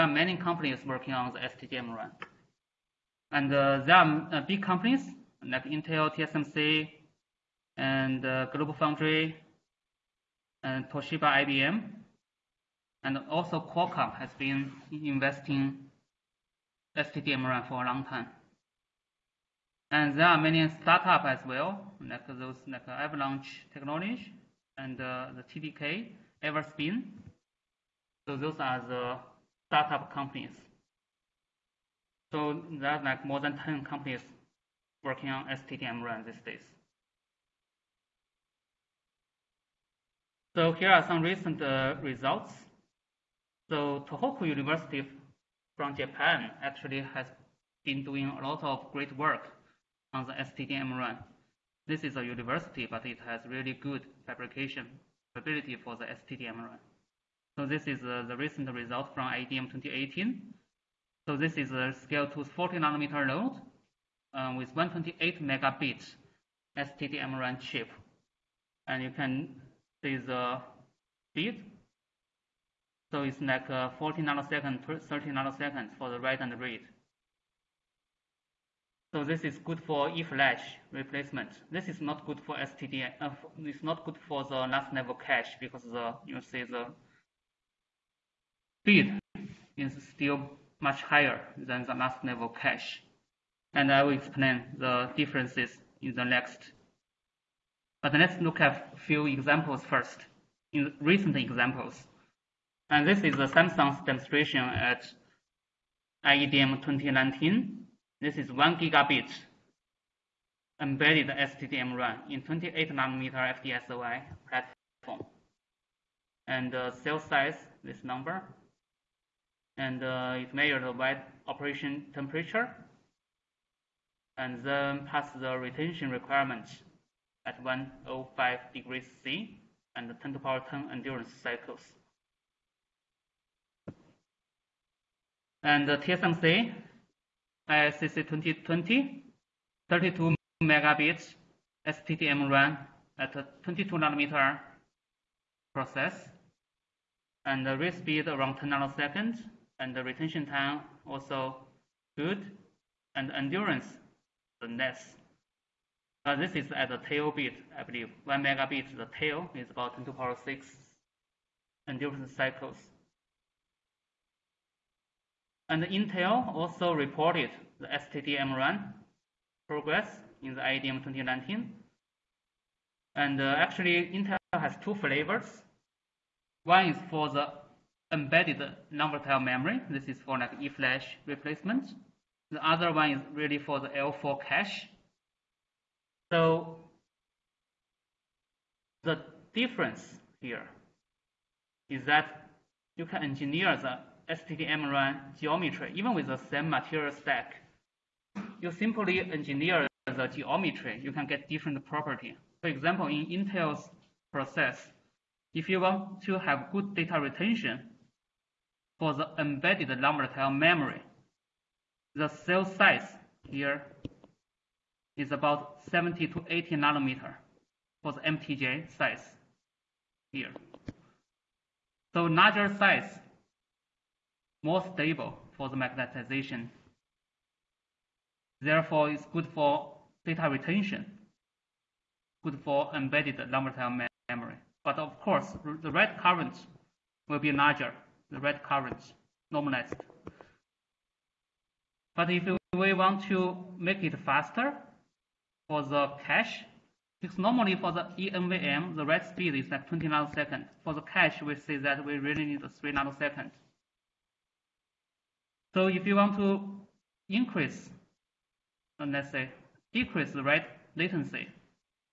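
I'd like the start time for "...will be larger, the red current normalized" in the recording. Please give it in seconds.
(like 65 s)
237 s.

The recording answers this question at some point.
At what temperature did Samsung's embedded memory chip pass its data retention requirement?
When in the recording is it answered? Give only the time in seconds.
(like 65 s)
127 s.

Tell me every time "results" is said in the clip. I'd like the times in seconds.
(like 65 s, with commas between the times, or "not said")
42 s, 58 s.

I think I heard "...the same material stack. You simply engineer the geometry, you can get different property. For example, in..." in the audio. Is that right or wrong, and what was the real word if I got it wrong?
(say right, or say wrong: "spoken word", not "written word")
right.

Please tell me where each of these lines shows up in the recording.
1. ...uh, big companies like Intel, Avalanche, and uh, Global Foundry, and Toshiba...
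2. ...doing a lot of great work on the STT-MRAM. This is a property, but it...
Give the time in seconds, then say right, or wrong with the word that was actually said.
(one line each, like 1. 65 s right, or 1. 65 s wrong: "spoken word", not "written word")
1. 4 s wrong: "TSMC", not "Avalanche"
2. 48 s wrong: "university", not "property".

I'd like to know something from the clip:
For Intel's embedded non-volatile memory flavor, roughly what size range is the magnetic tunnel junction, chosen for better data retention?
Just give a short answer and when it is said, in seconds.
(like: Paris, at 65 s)
70 to 80 nanometers, at 215 s.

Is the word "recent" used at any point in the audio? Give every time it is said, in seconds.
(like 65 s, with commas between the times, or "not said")
41 s, 58 s, 100 s.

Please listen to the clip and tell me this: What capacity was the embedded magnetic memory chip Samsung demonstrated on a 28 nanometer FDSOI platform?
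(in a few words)
1 gigabit.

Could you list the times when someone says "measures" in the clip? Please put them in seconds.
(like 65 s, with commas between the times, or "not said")
120 s.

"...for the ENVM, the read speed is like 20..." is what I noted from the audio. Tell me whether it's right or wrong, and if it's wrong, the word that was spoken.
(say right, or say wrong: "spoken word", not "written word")
right.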